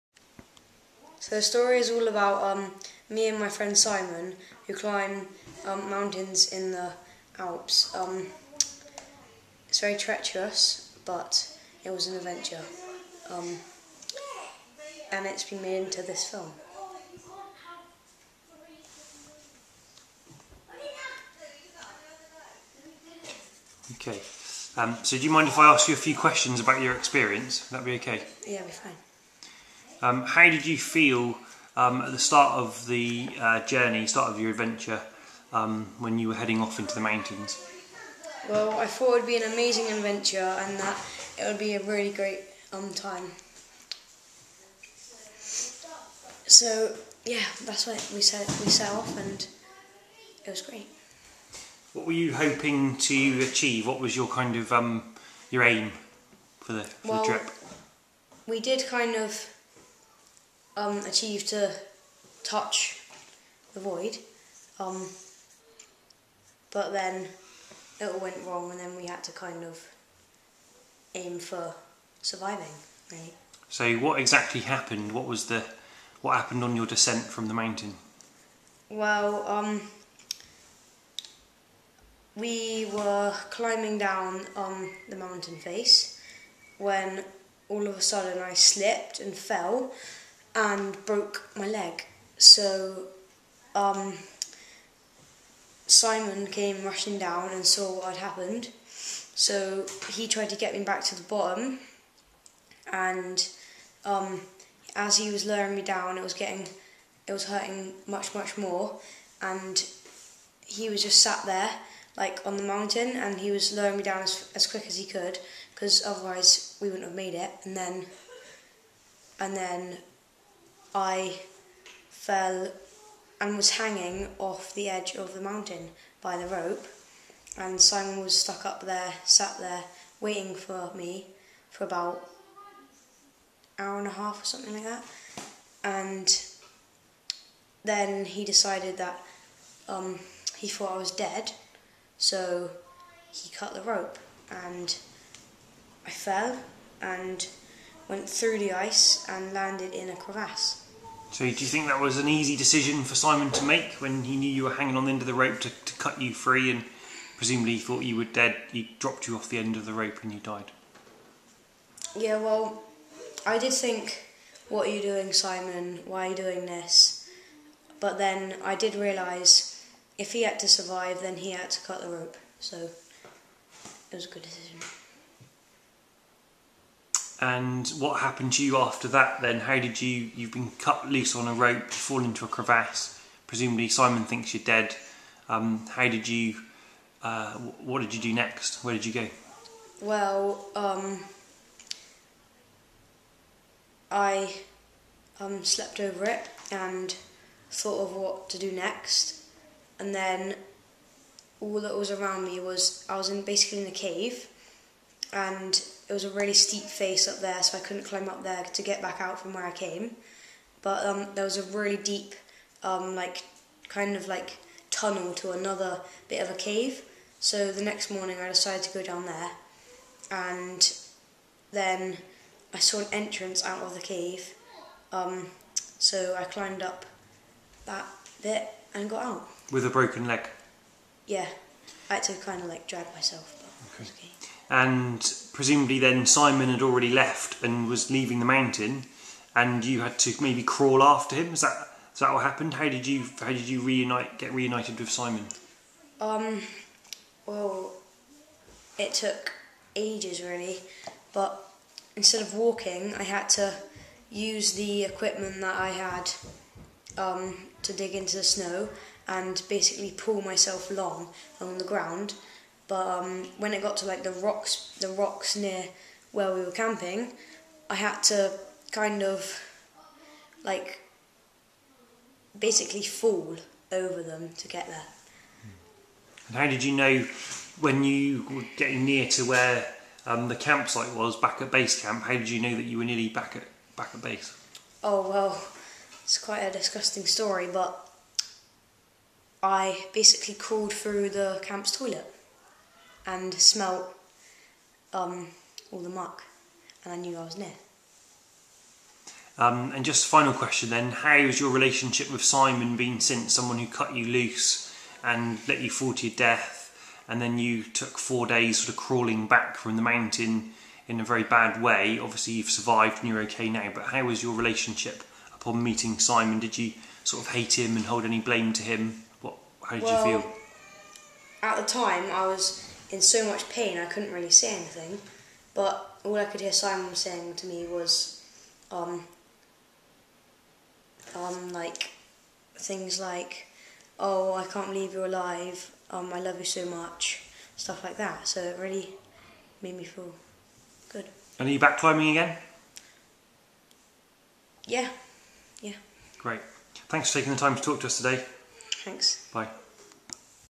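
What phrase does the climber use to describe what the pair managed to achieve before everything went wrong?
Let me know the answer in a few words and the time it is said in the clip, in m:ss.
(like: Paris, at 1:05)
Touch the void, at 1:02.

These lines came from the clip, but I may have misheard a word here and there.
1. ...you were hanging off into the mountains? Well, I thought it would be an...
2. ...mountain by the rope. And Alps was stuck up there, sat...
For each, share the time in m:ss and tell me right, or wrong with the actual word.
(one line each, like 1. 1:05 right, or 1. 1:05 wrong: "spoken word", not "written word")
1. 0:36 wrong: "heading", not "hanging"
2. 2:05 wrong: "Simon", not "Alps".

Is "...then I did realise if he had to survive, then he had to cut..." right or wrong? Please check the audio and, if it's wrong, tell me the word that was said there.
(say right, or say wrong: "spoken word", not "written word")
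right.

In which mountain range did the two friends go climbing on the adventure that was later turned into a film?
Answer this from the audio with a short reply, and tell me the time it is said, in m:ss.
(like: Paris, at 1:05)
The Alps, at 0:07.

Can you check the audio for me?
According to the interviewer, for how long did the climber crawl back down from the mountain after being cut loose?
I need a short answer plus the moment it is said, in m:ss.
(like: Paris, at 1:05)
4 days, at 5:08.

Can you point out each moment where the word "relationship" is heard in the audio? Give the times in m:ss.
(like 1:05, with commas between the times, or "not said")
5:01, 5:14.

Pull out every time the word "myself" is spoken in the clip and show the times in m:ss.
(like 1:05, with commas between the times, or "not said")
3:53, 4:20.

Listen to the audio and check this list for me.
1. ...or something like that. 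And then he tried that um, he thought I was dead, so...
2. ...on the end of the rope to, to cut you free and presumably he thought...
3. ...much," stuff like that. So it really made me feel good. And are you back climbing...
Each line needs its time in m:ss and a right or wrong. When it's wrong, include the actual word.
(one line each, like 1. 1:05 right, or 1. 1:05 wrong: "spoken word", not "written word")
1. 2:14 wrong: "decided", not "tried"
2. 2:34 right
3. 5:36 right.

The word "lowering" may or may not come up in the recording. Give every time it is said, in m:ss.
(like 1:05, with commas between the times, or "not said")
1:45, 1:53.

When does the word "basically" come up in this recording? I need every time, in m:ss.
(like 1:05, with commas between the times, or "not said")
3:23, 4:19, 4:32, 4:50.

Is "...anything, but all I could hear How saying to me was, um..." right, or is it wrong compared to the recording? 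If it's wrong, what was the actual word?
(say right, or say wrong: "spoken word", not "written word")
wrong: "Simon", not "How".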